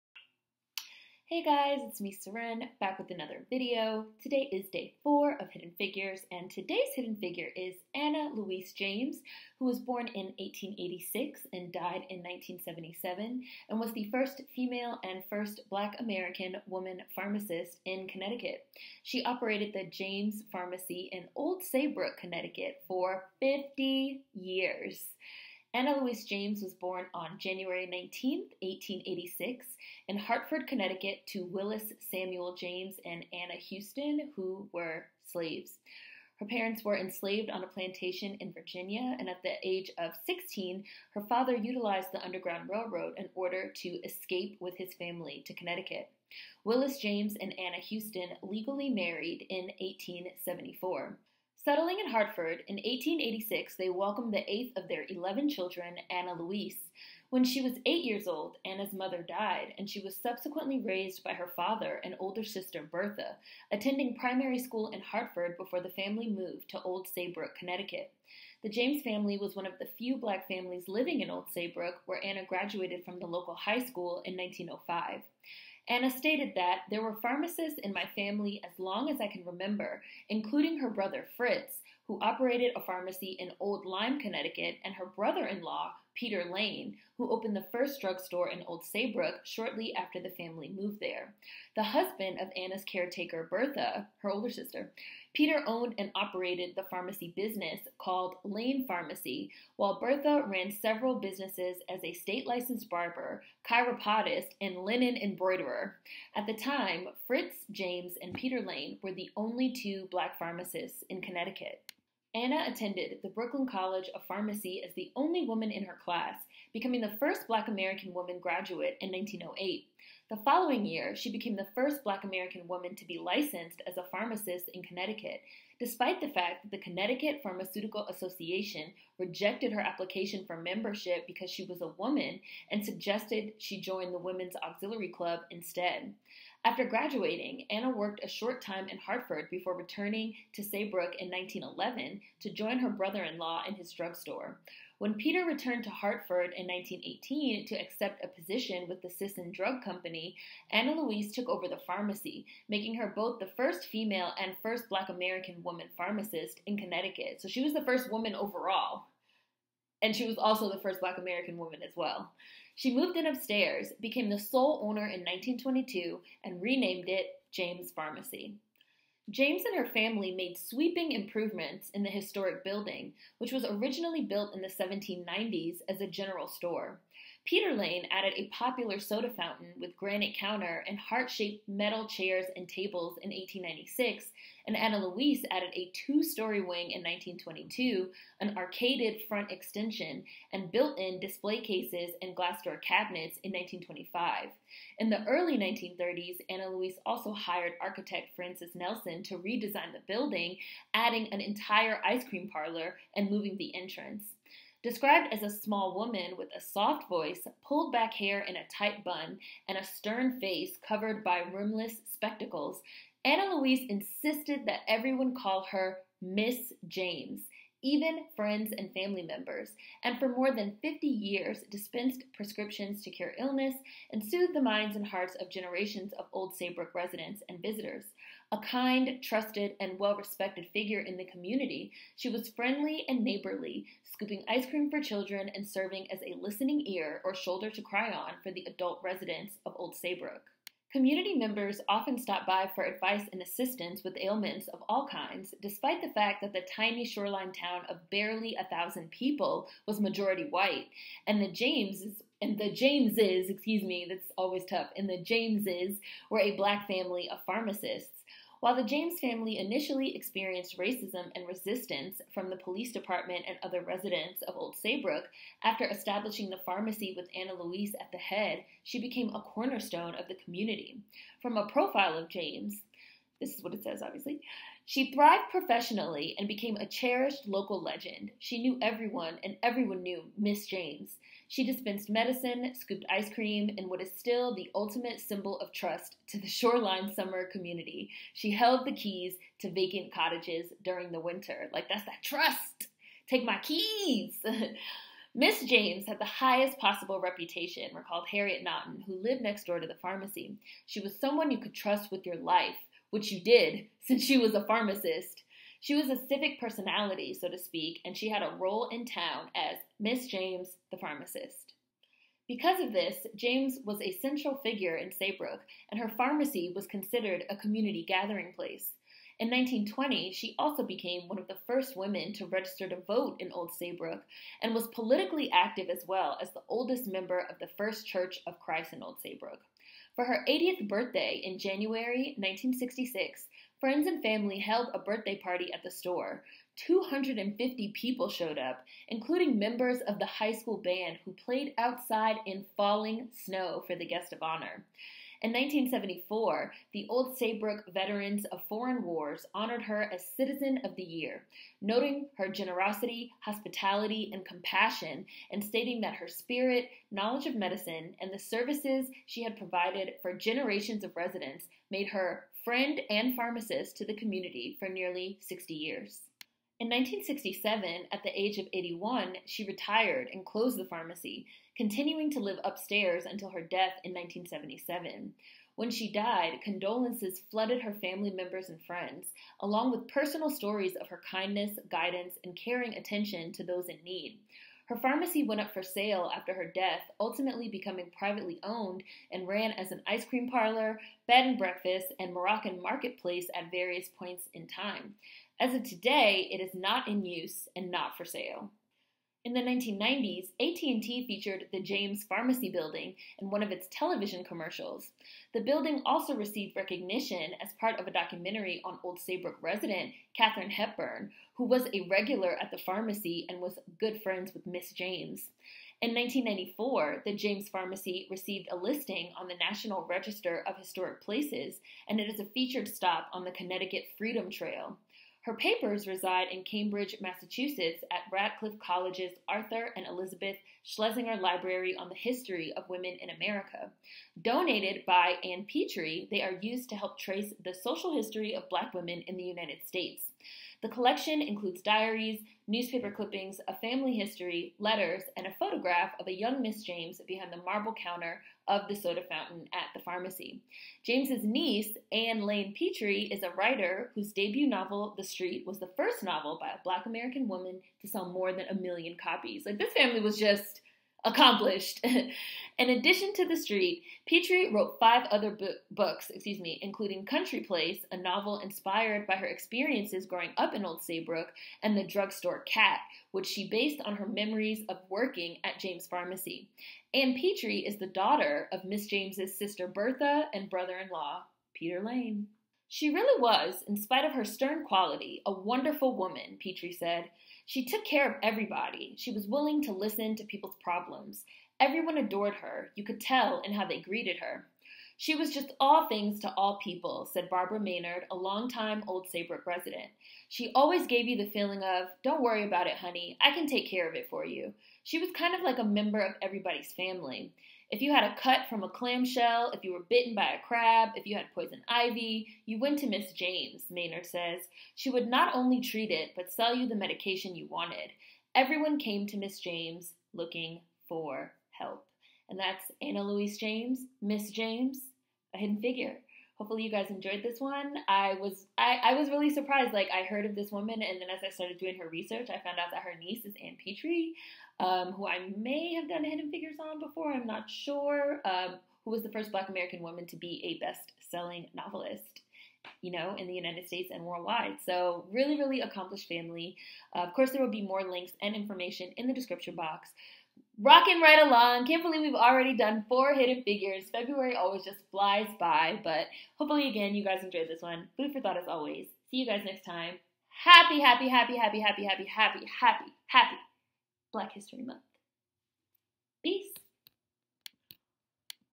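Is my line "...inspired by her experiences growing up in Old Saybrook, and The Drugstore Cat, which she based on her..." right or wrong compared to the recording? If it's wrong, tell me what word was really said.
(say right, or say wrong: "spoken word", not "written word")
right.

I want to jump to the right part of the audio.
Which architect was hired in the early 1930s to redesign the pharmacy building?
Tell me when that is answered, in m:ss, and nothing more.
3:18.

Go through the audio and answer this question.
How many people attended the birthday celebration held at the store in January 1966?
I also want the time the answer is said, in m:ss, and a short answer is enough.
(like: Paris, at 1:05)
250, at 5:36.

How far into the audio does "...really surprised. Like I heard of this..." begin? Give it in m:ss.
8:49.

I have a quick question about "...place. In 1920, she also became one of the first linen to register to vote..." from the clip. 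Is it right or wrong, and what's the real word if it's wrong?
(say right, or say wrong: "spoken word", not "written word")
wrong: "women", not "linen".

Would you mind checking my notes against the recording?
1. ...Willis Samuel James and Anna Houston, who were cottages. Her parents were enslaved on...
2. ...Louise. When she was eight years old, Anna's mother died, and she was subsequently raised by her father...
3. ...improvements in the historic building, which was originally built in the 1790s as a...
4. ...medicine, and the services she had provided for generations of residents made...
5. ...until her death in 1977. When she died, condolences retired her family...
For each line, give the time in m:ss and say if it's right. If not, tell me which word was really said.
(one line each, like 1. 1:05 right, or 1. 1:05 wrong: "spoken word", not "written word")
1. 0:31 wrong: "slaves", not "cottages"
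2. 0:56 right
3. 2:51 right
4. 5:57 right
5. 6:13 wrong: "flooded", not "retired".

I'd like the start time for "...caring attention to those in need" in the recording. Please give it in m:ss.
6:22.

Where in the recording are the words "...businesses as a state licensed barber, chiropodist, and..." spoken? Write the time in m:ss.
1:41.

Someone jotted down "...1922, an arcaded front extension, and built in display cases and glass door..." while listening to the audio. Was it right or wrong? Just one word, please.
right.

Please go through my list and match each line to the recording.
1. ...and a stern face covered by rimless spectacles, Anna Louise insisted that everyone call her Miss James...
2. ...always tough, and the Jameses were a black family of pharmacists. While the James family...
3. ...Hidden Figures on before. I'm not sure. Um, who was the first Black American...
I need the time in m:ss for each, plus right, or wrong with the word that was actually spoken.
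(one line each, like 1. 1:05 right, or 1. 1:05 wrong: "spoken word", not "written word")
1. 3:29 right
2. 4:14 right
3. 8:56 right.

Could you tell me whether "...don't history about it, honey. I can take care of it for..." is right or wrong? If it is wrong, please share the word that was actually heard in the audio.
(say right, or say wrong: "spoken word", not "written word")
wrong: "worry", not "history".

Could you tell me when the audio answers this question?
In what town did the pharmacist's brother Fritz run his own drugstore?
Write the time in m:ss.
1:23.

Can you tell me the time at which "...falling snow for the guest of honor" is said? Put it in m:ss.
5:42.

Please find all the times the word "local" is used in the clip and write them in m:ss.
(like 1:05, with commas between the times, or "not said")
1:13, 4:37.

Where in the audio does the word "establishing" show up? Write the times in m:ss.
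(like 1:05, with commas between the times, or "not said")
4:25.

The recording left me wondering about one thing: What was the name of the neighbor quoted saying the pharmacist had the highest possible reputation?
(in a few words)
Harriet Naughton.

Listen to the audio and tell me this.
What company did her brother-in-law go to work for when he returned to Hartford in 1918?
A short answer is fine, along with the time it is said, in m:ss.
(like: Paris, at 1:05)
Sisson Drug Company, at 2:29.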